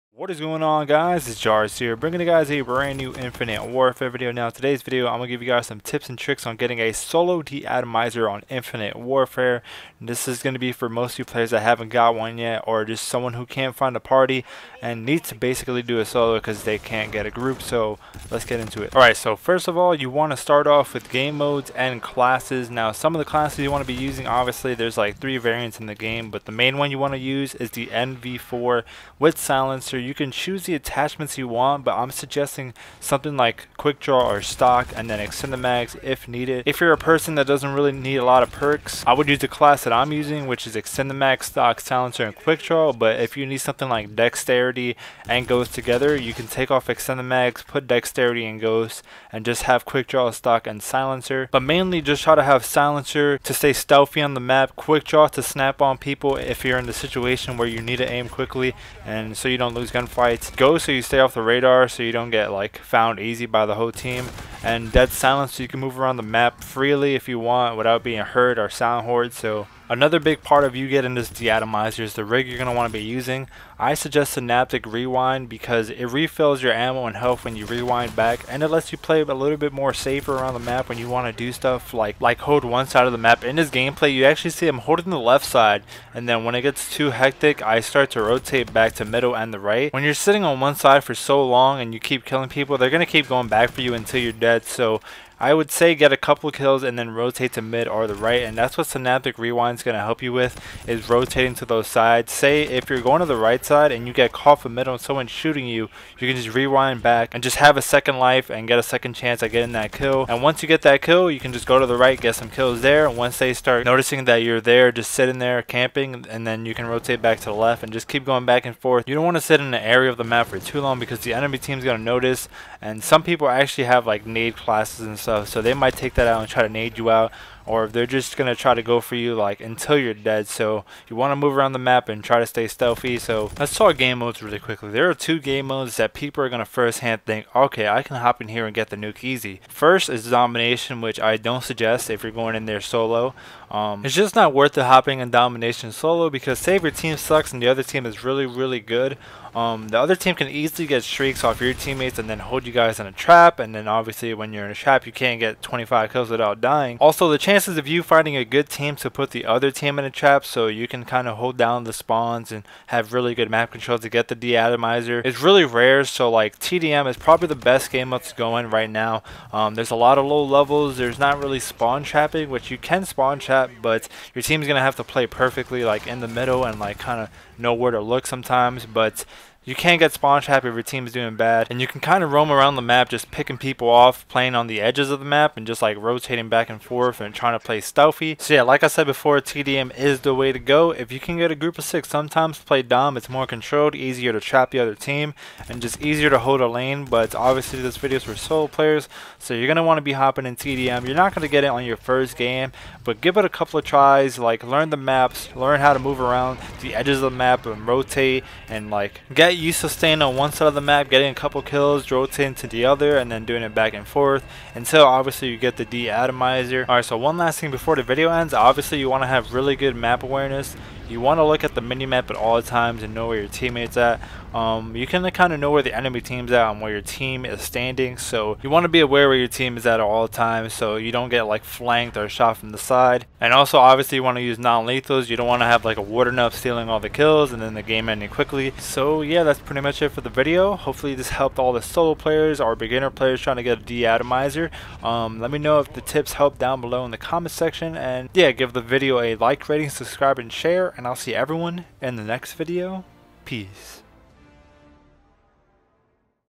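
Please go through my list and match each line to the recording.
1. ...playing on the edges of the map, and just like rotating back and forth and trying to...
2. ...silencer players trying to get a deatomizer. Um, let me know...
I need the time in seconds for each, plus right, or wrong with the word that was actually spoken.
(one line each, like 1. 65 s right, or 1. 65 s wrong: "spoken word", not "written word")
1. 184 s right
2. 242 s wrong: "beginner", not "silencer".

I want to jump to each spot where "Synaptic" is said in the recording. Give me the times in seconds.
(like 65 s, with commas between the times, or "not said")
74 s, 98 s.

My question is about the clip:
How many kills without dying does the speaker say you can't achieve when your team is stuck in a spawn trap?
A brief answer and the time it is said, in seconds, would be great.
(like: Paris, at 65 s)
25, at 155 s.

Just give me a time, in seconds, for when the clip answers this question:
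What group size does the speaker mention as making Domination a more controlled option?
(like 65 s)
191 s.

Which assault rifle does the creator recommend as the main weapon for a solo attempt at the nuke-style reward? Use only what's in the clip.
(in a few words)
NV4.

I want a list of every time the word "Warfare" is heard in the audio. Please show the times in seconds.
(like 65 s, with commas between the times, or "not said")
3 s, 8 s.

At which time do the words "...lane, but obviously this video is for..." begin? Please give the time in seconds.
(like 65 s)
196 s.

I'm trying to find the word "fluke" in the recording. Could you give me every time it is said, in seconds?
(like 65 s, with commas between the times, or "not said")
not said.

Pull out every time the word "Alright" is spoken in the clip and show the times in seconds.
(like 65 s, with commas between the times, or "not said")
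18 s, 216 s.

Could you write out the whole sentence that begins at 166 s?
So like TDM is probably the best game that's going right now.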